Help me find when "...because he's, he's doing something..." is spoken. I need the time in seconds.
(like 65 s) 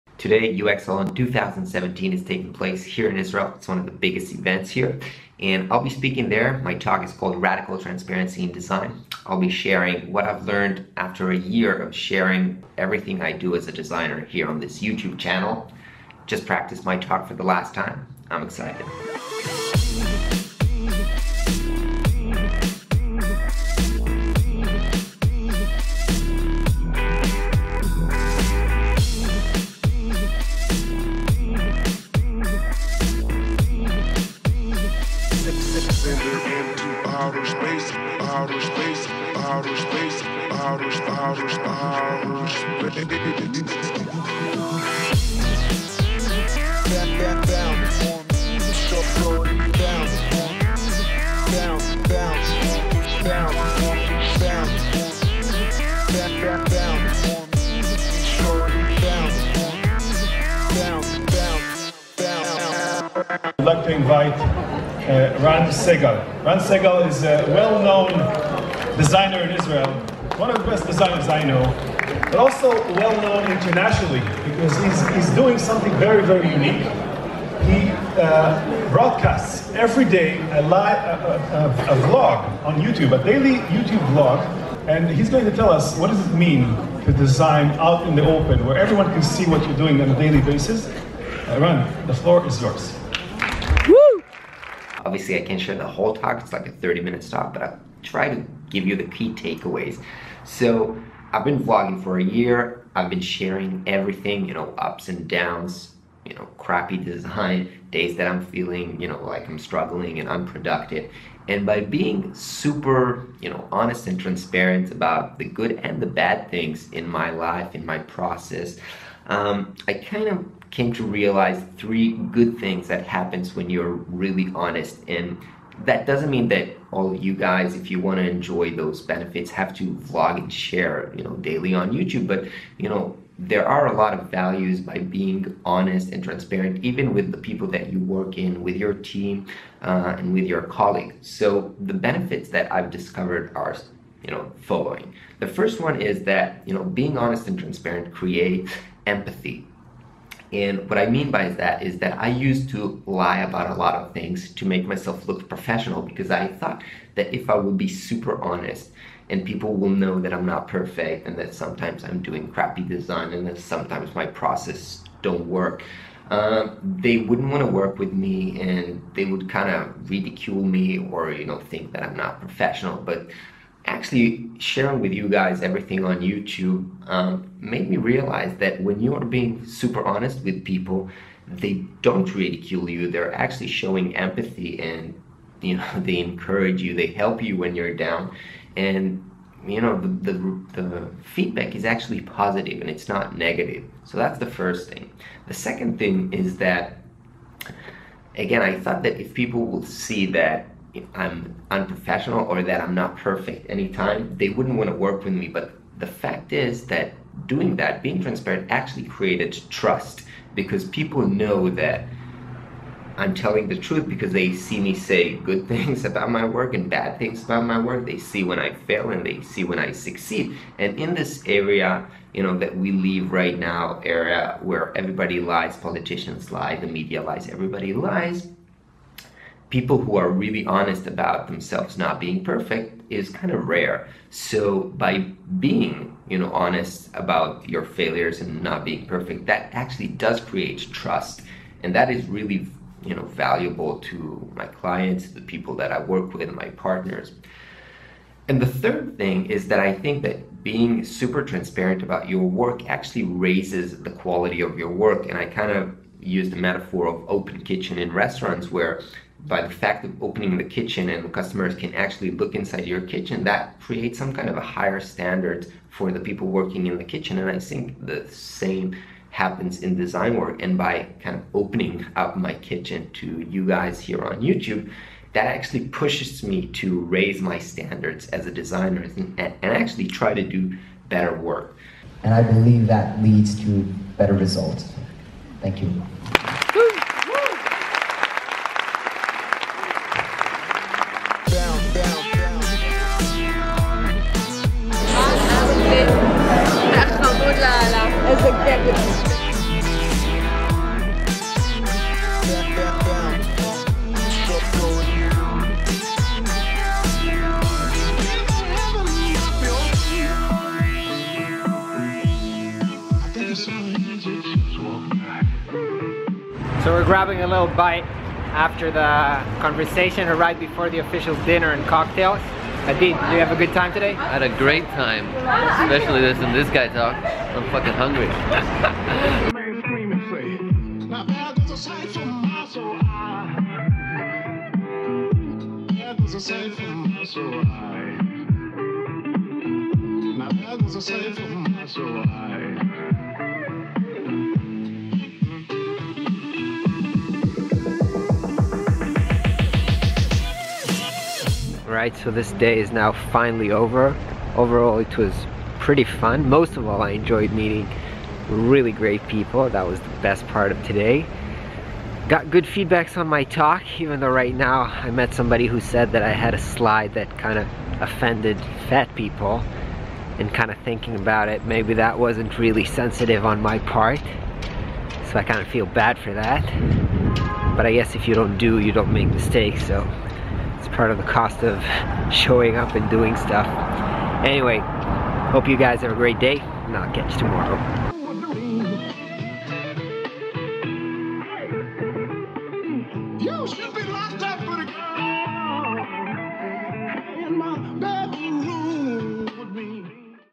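74 s.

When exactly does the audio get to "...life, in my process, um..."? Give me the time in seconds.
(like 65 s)
117 s.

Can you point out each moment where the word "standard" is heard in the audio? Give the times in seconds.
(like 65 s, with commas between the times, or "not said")
264 s, 277 s.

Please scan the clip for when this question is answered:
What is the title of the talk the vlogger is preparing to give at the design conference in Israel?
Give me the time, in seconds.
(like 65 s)
7 s.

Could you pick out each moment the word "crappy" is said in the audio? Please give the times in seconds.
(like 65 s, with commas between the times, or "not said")
106 s, 162 s.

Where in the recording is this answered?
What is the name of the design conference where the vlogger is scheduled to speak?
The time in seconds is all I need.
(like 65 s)
0 s.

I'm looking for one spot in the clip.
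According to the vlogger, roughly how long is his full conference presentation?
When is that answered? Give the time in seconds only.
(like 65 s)
96 s.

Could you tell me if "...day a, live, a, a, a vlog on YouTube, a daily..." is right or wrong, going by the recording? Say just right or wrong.
right.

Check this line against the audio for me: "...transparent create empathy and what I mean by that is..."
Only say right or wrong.
right.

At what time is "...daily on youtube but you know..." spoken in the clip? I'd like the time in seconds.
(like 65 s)
131 s.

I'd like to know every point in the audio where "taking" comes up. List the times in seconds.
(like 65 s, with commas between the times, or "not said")
2 s.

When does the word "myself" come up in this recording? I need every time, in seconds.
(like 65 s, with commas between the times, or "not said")
154 s.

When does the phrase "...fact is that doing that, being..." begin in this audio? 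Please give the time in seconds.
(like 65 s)
206 s.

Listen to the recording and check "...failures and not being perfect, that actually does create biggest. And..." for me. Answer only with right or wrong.
wrong.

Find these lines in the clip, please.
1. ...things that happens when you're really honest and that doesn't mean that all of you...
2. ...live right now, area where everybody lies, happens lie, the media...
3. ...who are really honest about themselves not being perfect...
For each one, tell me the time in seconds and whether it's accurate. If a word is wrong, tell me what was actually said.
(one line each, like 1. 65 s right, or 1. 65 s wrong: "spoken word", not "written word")
1. 122 s right
2. 222 s wrong: "politicians", not "happens"
3. 229 s right.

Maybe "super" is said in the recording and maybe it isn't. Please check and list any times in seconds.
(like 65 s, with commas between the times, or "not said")
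112 s, 157 s, 179 s, 251 s.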